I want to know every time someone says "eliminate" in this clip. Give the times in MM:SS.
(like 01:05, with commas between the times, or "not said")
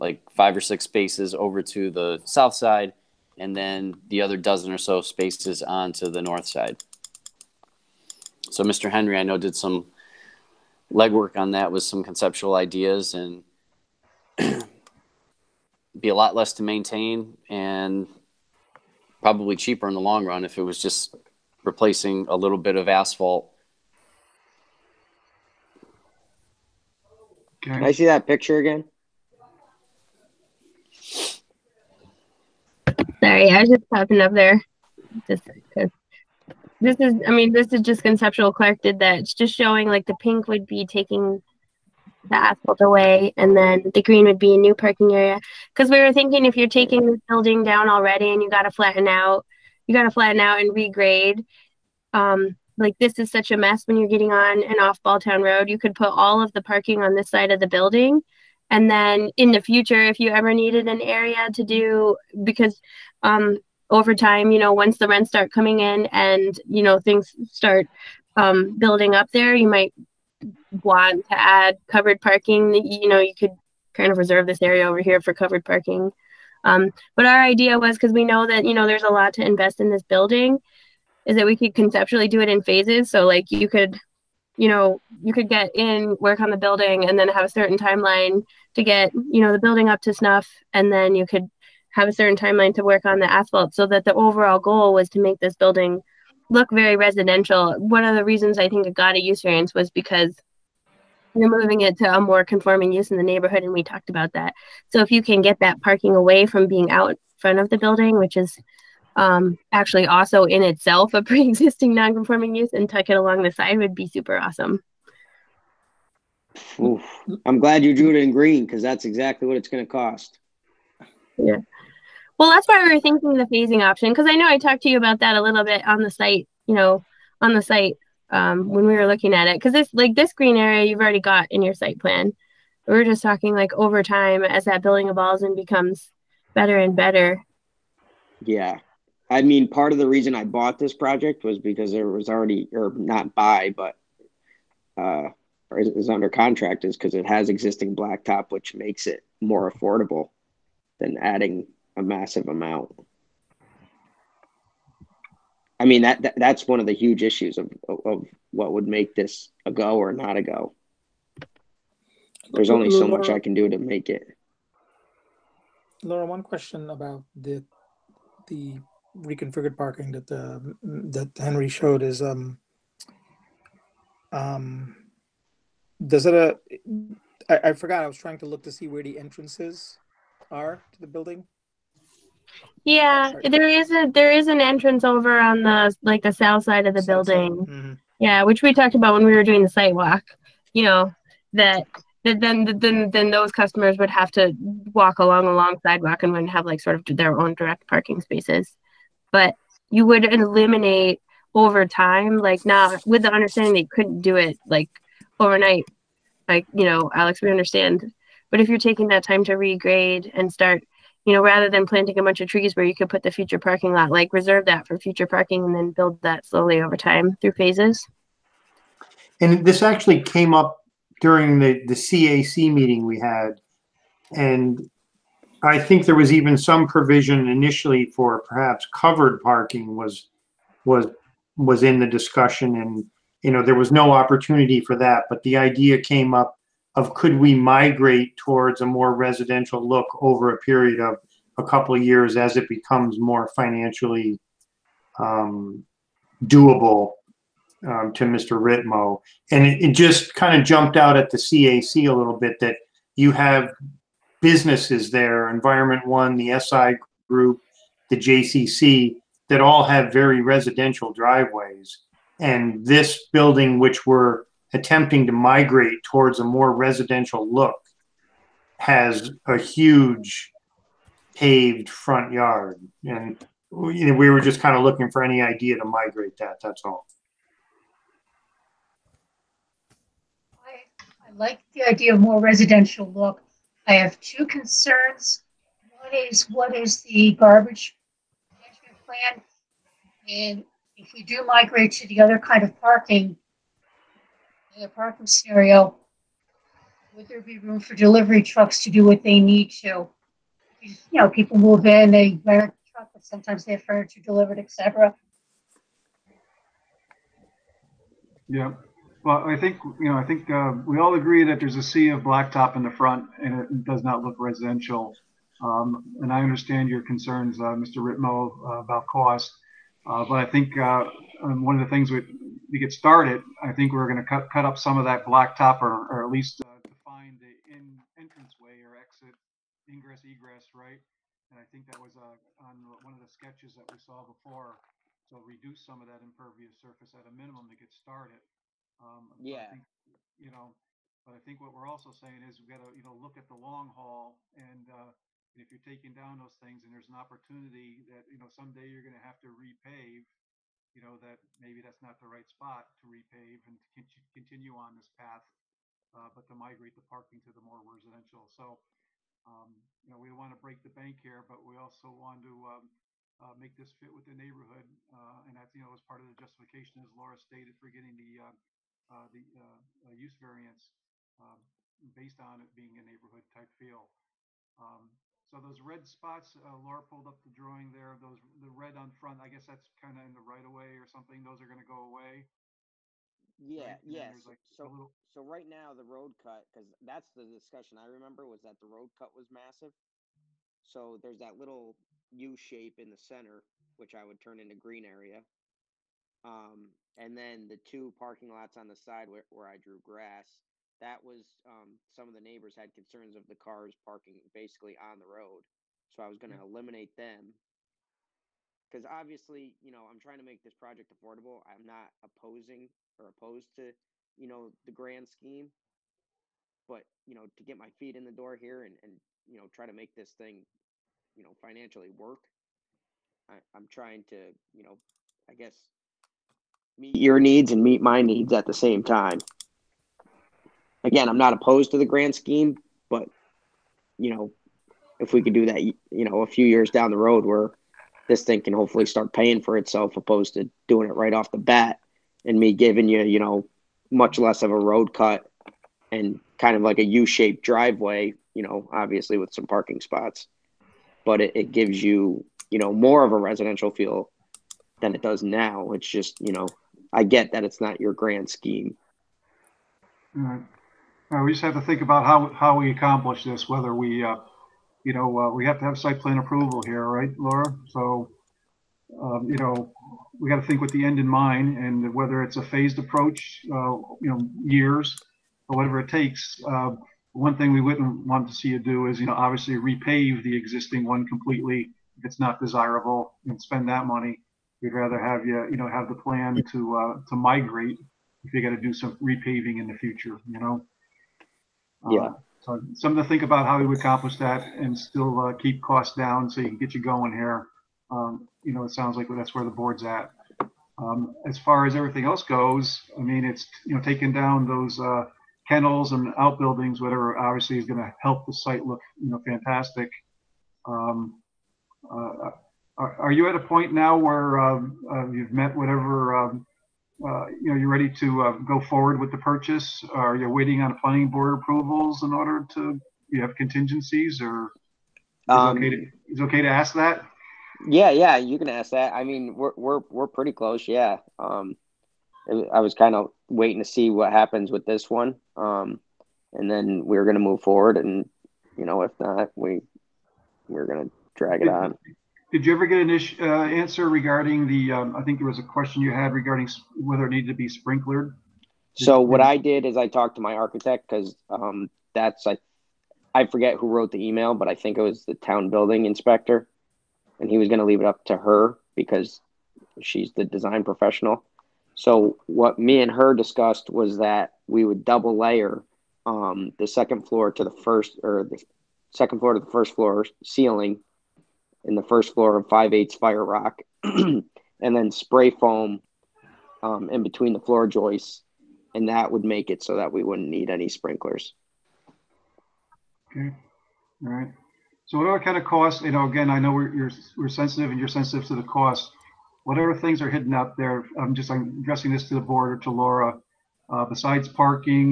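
03:20, 06:46.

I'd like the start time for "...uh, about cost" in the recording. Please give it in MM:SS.
05:18.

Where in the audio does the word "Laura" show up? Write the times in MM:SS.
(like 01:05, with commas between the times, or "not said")
02:46, 06:07, 06:16, 07:47, 09:52.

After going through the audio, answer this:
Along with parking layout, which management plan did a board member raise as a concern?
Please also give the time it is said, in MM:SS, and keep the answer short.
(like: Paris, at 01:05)
Garbage management plan, at 04:47.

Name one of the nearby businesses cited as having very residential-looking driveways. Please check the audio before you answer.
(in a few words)
Environment One.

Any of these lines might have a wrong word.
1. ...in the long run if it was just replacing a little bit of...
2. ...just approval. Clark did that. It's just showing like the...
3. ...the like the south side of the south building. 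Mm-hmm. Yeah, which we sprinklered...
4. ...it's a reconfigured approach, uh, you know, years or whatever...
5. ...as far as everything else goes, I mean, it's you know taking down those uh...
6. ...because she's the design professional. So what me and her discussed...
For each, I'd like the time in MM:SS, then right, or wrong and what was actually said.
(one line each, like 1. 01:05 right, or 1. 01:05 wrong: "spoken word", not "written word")
1. 00:19 right
2. 00:37 wrong: "conceptual", not "approval"
3. 03:05 wrong: "talked", not "sprinklered"
4. 07:52 wrong: "phased", not "reconfigured"
5. 08:21 right
6. 09:18 right.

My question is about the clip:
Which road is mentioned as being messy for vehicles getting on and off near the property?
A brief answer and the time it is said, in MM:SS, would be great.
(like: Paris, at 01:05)
Balltown Road, at 00:55.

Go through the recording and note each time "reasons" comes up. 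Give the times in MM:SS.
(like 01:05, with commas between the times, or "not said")
01:38, 02:20.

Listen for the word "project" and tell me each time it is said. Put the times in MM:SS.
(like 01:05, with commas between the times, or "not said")
02:20, 06:50.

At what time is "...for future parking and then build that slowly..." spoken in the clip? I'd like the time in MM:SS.
03:34.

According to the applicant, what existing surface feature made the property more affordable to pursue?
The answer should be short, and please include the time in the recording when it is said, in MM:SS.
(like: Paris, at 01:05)
Existing blacktop, at 02:27.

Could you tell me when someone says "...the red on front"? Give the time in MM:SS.
06:18.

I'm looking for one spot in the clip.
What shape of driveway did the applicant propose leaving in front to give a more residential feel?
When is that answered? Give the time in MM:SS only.
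07:27.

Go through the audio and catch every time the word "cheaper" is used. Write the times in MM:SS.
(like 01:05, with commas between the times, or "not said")
00:19.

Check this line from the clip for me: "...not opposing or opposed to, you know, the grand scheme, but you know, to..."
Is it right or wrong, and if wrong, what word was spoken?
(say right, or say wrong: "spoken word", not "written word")
right.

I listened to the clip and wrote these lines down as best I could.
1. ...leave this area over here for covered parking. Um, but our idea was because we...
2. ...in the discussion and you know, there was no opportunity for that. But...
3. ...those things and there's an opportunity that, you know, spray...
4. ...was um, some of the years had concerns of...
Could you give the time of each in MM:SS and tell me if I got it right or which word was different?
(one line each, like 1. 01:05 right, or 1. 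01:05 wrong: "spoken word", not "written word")
1. 01:14 wrong: "reserve", not "leave"
2. 03:51 right
3. 05:46 wrong: "someday", not "spray"
4. 06:41 wrong: "neighbors", not "years".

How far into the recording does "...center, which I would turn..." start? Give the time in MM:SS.
06:33.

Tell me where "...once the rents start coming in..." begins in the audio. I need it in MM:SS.
01:04.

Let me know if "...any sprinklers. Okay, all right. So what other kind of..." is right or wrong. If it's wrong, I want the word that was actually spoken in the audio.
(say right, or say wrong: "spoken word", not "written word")
right.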